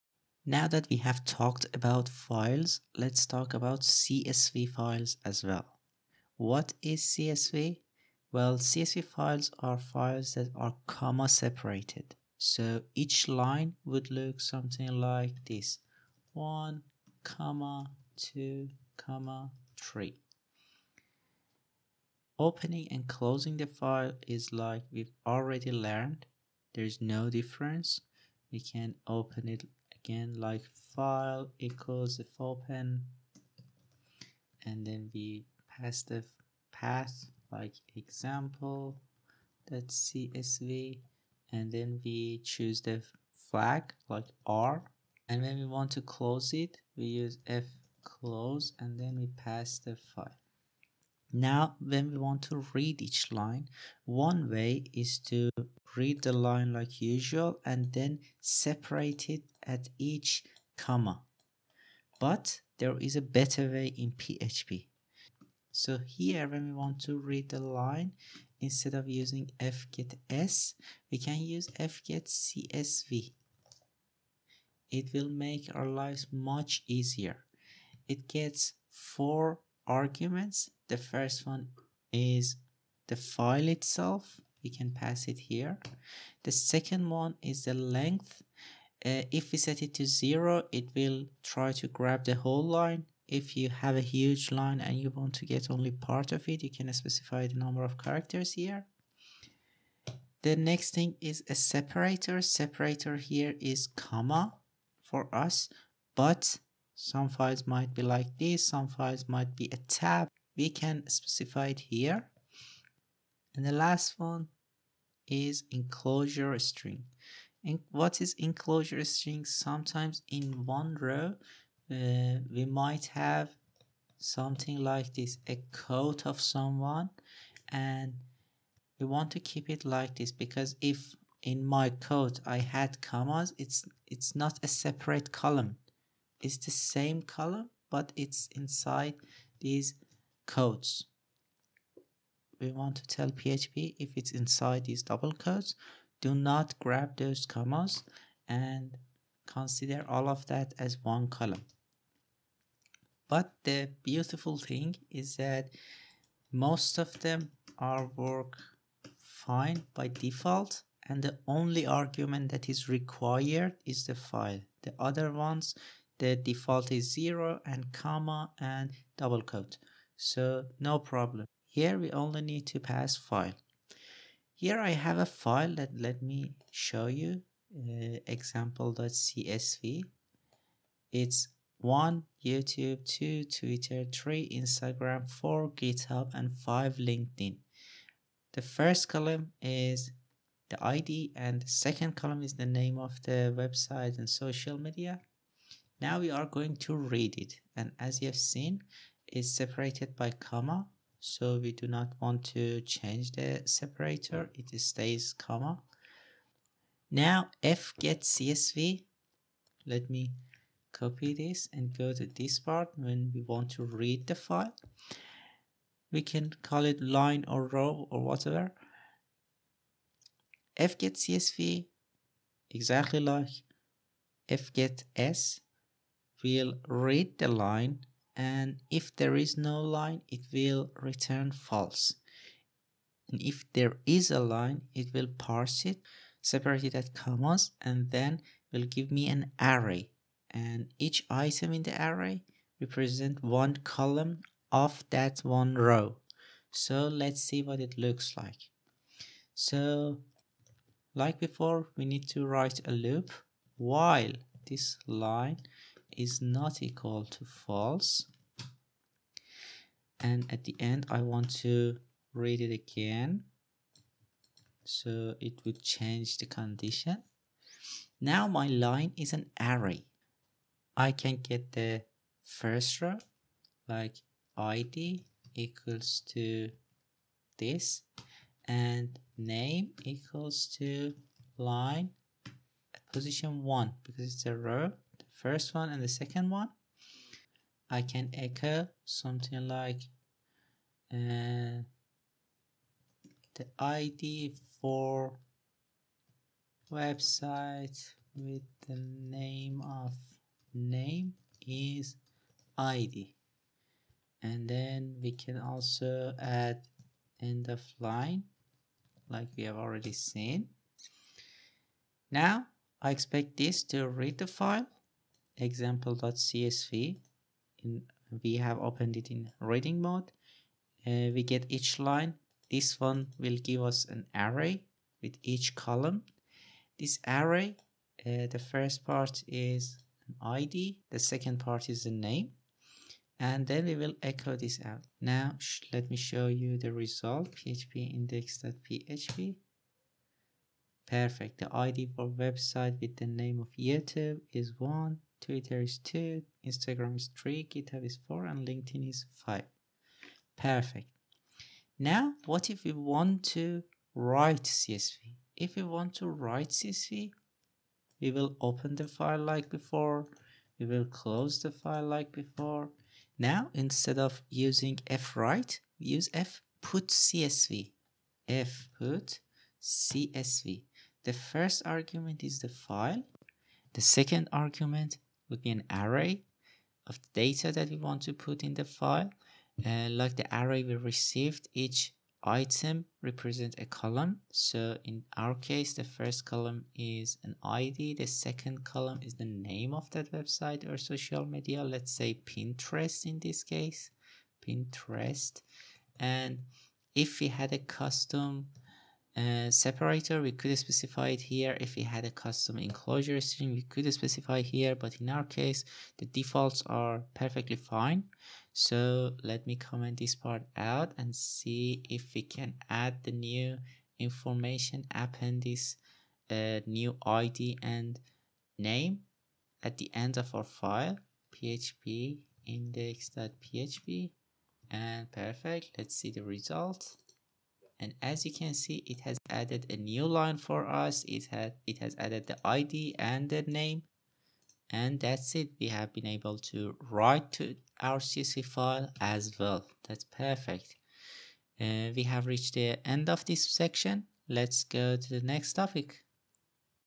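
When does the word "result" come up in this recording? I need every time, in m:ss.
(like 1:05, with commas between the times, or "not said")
5:36, 7:06.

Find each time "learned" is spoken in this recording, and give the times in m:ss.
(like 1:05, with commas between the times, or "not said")
0:25.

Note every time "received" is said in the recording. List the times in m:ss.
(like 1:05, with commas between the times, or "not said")
6:20.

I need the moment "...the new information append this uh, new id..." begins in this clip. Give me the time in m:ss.
6:53.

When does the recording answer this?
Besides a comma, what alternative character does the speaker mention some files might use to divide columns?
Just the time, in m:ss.
1:49.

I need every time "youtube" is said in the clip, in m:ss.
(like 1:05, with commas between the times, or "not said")
3:02, 5:43.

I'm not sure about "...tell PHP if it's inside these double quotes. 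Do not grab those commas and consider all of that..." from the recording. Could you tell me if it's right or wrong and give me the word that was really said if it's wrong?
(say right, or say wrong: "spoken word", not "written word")
right.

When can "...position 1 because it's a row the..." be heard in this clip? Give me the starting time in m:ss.
4:43.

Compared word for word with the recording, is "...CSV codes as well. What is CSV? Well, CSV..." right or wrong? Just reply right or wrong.
wrong.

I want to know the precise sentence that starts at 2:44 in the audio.
The other ones, the default is zero and comma and double quote.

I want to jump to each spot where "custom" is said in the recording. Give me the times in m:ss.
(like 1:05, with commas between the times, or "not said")
6:37, 6:42.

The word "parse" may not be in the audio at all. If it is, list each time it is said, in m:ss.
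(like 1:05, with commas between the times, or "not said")
3:55.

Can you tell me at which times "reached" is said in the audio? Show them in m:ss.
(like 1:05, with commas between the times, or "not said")
7:22.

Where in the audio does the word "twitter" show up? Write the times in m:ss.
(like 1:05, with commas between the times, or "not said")
3:03, 5:45.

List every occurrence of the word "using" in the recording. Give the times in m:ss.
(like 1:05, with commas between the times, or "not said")
1:09, 6:04.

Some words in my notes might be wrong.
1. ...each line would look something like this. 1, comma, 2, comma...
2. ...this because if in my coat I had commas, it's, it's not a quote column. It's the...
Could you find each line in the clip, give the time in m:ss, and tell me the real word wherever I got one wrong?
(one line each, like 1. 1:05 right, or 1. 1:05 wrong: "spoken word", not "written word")
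1. 0:12 right
2. 2:10 wrong: "separate", not "quote".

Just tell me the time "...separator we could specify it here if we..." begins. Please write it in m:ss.
6:39.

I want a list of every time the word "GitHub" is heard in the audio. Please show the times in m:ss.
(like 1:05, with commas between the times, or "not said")
3:05, 5:47.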